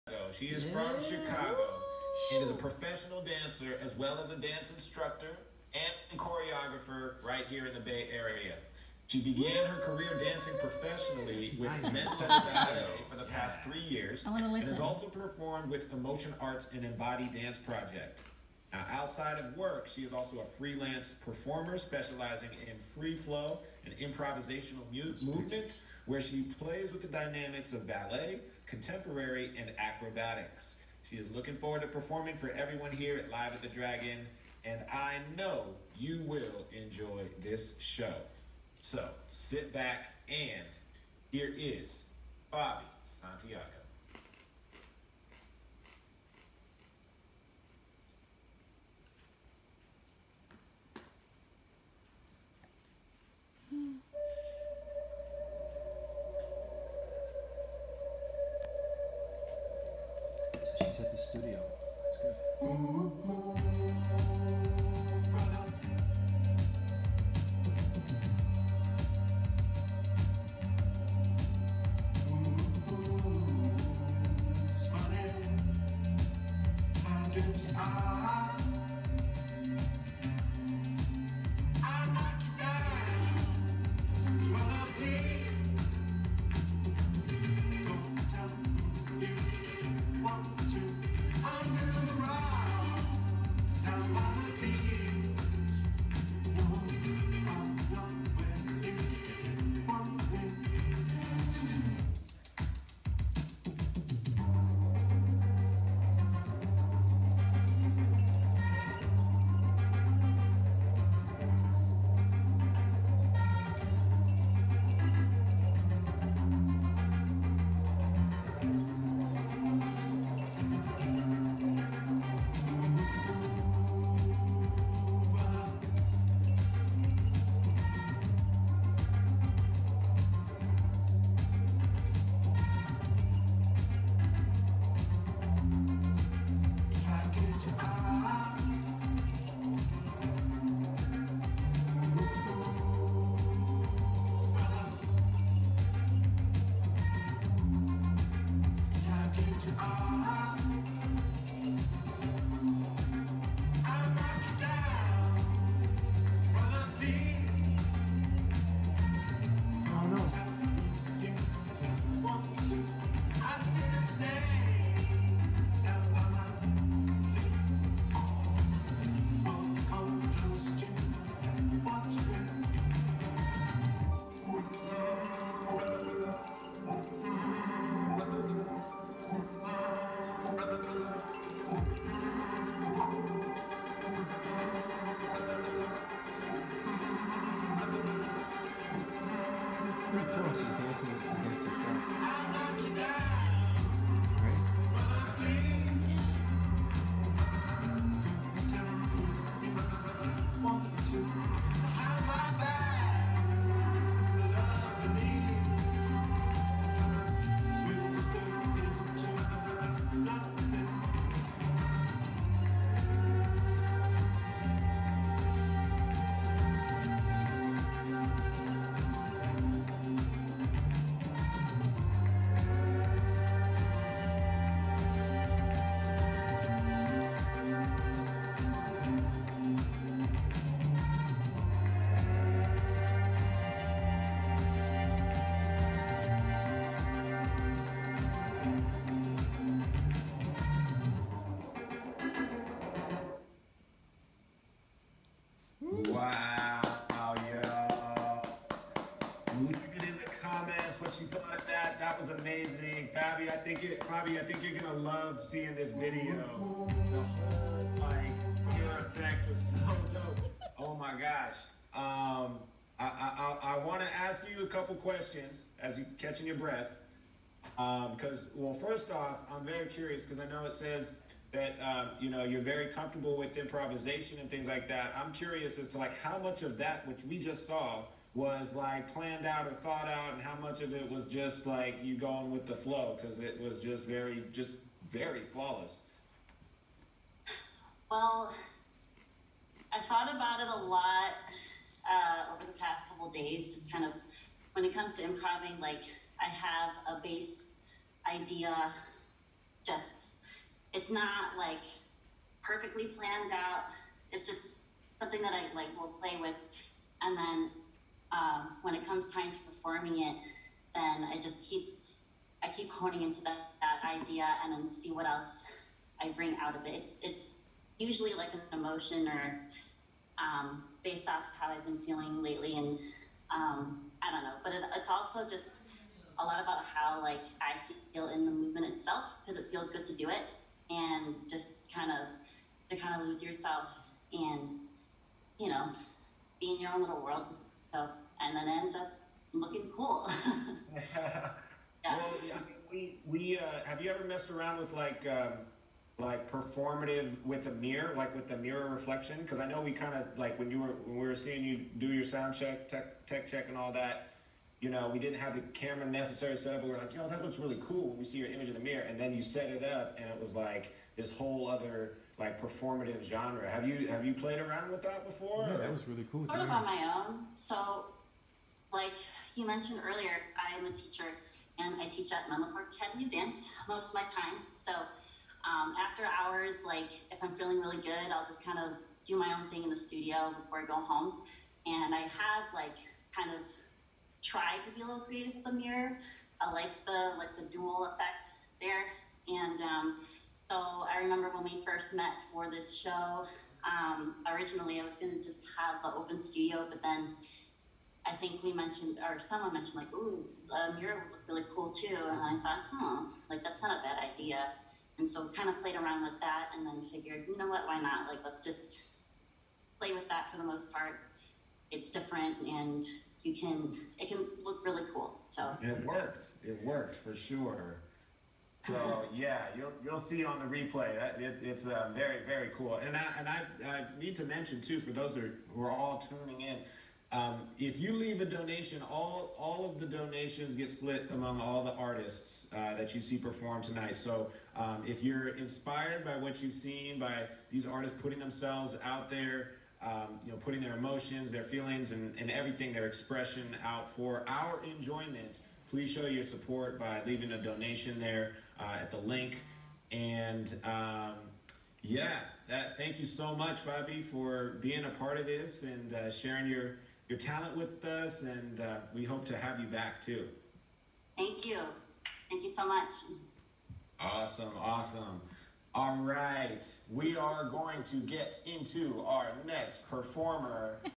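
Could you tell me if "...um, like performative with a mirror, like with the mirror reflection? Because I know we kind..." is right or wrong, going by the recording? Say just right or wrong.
right.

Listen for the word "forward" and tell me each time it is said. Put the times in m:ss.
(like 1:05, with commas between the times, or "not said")
0:31.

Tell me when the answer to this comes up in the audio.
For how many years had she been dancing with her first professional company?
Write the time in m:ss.
0:13.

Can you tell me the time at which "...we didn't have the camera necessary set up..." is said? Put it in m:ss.
5:55.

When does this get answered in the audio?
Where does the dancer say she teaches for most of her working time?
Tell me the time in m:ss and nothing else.
6:12.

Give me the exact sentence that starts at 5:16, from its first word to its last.
It's it's usually like an emotion or um, based off how I've been feeling lately, and um, I don't know.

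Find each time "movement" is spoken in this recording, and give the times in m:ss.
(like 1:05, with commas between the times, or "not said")
0:25, 5:28.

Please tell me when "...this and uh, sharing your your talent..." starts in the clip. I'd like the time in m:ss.
7:35.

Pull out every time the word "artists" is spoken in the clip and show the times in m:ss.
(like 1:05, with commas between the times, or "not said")
7:11, 7:17.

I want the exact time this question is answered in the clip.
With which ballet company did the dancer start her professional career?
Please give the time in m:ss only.
0:11.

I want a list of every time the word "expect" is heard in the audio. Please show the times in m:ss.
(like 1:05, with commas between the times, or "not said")
not said.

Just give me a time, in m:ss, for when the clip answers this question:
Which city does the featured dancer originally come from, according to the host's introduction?
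0:01.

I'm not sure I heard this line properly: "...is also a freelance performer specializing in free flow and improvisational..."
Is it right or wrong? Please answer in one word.
right.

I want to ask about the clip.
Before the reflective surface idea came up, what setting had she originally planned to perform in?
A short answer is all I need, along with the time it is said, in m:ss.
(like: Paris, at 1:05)
open studio, at 6:36.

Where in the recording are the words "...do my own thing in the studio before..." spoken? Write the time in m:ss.
6:19.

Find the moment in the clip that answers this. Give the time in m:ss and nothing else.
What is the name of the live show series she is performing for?
0:33.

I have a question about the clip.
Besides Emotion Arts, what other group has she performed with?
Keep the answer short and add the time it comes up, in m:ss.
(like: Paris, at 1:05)
Embody Dance Project, at 0:16.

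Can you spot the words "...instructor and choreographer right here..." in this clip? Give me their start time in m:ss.
0:04.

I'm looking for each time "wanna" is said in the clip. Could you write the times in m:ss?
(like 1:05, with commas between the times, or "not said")
4:23.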